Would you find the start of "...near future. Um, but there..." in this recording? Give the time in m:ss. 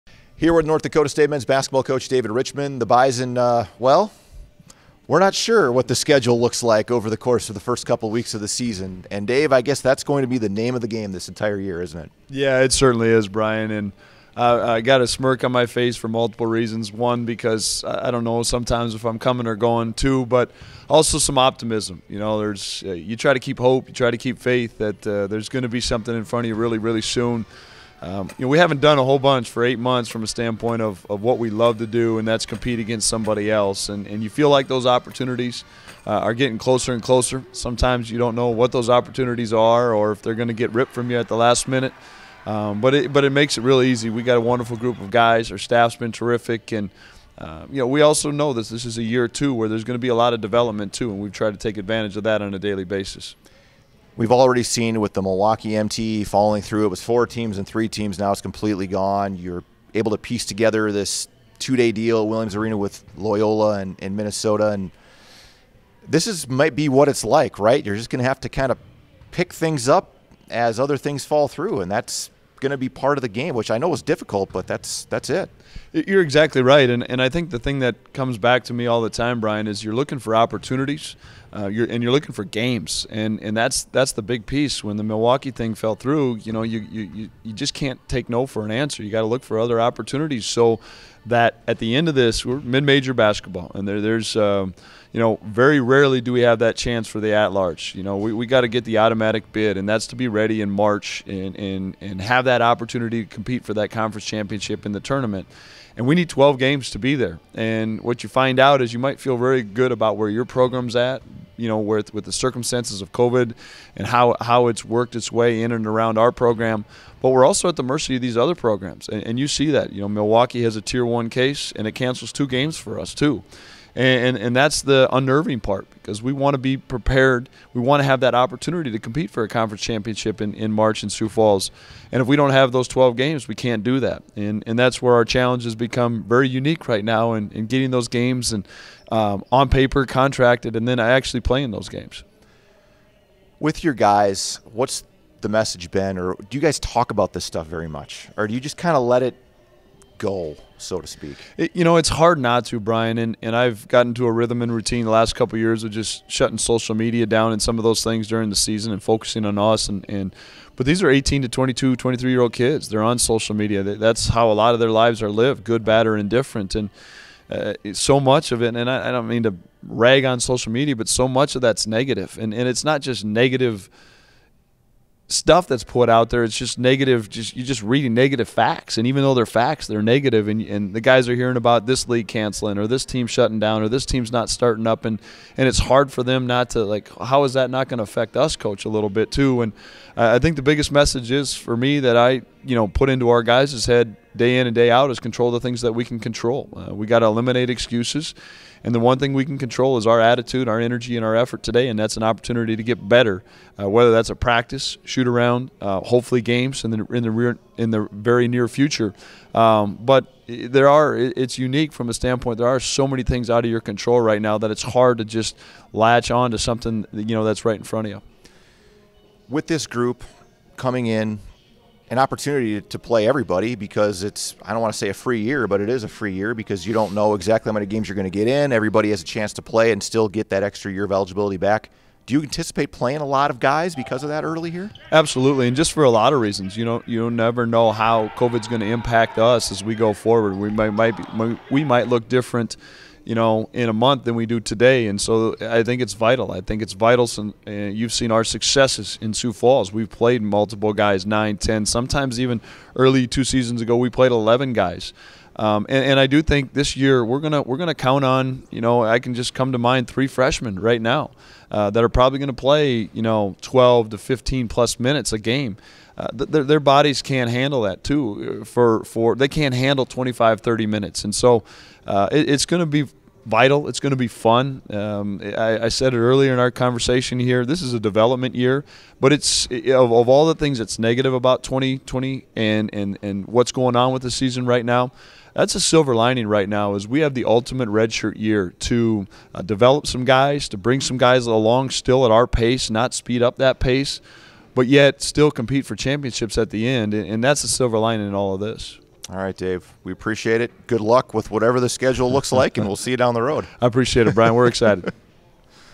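3:28.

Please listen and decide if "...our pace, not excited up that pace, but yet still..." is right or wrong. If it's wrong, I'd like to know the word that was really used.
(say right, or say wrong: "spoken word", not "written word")
wrong: "speed", not "excited".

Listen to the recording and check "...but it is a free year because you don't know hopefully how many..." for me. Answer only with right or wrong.
wrong.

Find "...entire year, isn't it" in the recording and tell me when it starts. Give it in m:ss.
0:11.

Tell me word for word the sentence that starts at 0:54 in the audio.
We've already seen with the Milwaukee MT falling through.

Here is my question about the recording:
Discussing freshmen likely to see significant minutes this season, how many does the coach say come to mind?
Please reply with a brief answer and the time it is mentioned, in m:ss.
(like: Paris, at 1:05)
3, at 4:20.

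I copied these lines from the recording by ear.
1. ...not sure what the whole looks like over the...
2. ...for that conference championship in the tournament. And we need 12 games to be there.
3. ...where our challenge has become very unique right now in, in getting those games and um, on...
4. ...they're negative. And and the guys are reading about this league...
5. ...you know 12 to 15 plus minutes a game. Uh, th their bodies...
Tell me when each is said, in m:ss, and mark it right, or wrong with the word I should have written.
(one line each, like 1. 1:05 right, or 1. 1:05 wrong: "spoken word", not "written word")
1. 0:05 wrong: "schedule", not "whole"
2. 1:43 right
3. 2:15 right
4. 2:59 wrong: "hearing", not "reading"
5. 4:23 right.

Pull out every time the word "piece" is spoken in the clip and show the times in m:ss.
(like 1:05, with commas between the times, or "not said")
1:00, 1:24.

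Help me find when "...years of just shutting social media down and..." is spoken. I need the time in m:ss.
2:35.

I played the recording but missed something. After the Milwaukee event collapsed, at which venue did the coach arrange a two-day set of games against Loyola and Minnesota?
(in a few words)
Williams Arena.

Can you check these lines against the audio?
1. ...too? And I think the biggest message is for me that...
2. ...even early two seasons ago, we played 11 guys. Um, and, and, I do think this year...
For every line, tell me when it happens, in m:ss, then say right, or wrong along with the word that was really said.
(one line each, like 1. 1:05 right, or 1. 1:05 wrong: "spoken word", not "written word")
1. 3:09 right
2. 4:12 right.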